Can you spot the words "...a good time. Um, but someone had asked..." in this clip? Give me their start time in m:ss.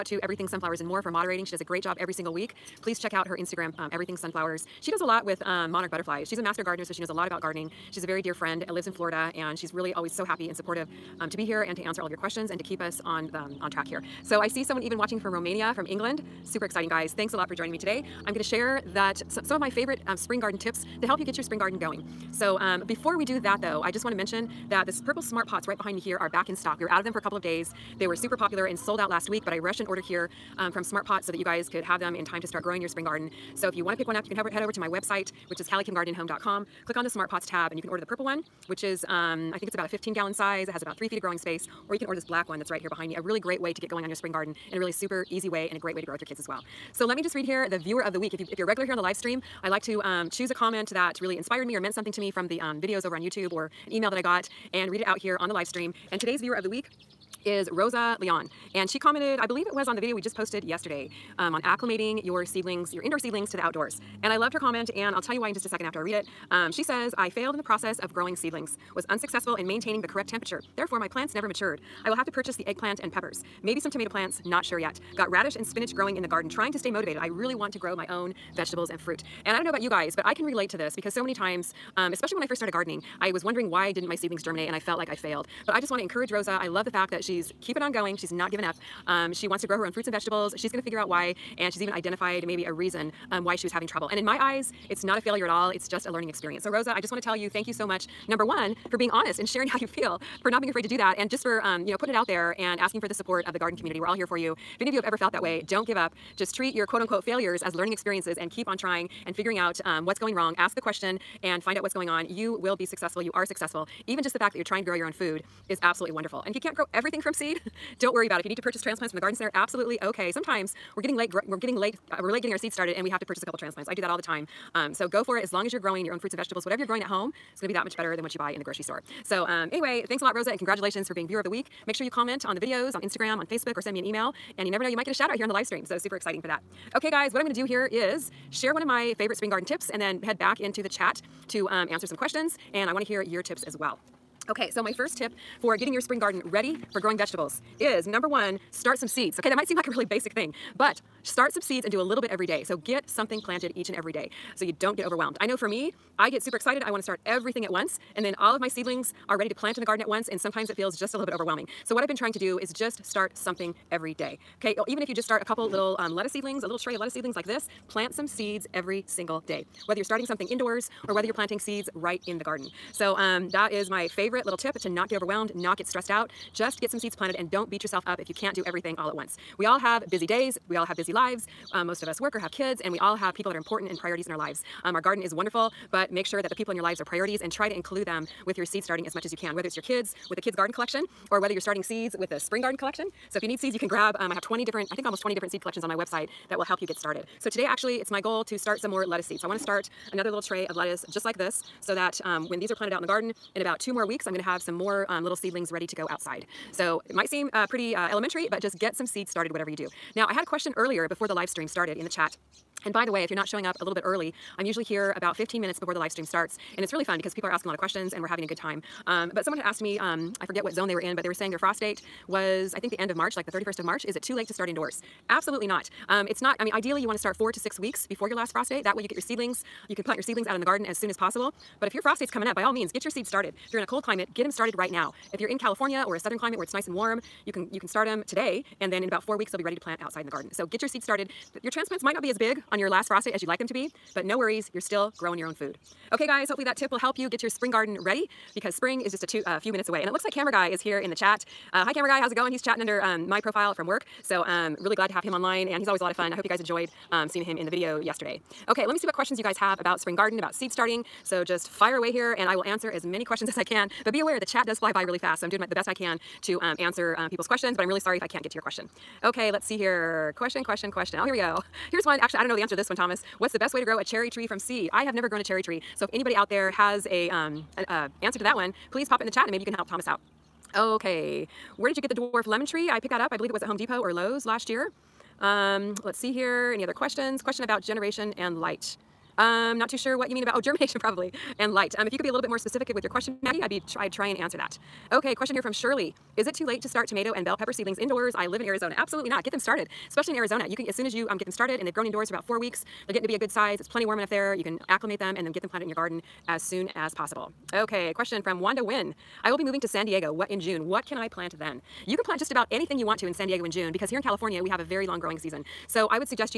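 3:38.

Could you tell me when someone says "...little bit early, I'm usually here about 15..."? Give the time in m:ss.
3:33.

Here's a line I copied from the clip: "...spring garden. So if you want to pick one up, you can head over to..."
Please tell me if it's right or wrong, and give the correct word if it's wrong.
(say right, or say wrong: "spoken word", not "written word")
right.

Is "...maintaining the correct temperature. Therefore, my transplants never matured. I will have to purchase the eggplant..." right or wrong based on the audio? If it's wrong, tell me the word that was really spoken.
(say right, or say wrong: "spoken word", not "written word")
wrong: "plants", not "transplants".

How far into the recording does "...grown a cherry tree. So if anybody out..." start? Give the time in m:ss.
4:35.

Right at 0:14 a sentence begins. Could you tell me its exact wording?
So I see someone even watching from Romania, from England.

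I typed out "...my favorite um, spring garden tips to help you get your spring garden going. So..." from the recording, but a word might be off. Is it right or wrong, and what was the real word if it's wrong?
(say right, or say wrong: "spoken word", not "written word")
right.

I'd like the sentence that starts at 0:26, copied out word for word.
We were out of them for a couple of days.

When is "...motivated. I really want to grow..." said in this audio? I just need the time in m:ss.
1:16.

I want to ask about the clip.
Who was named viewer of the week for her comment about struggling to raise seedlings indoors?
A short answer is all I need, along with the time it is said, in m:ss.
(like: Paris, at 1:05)
Rosa Leon, at 0:57.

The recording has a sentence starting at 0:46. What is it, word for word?
So let me just read here the viewer of the week.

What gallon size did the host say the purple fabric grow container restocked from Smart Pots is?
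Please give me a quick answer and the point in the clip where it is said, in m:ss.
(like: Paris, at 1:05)
15 gallon, at 0:39.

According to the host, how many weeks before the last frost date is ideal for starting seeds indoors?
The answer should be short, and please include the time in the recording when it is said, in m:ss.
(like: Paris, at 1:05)
4 to 6 weeks, at 3:47.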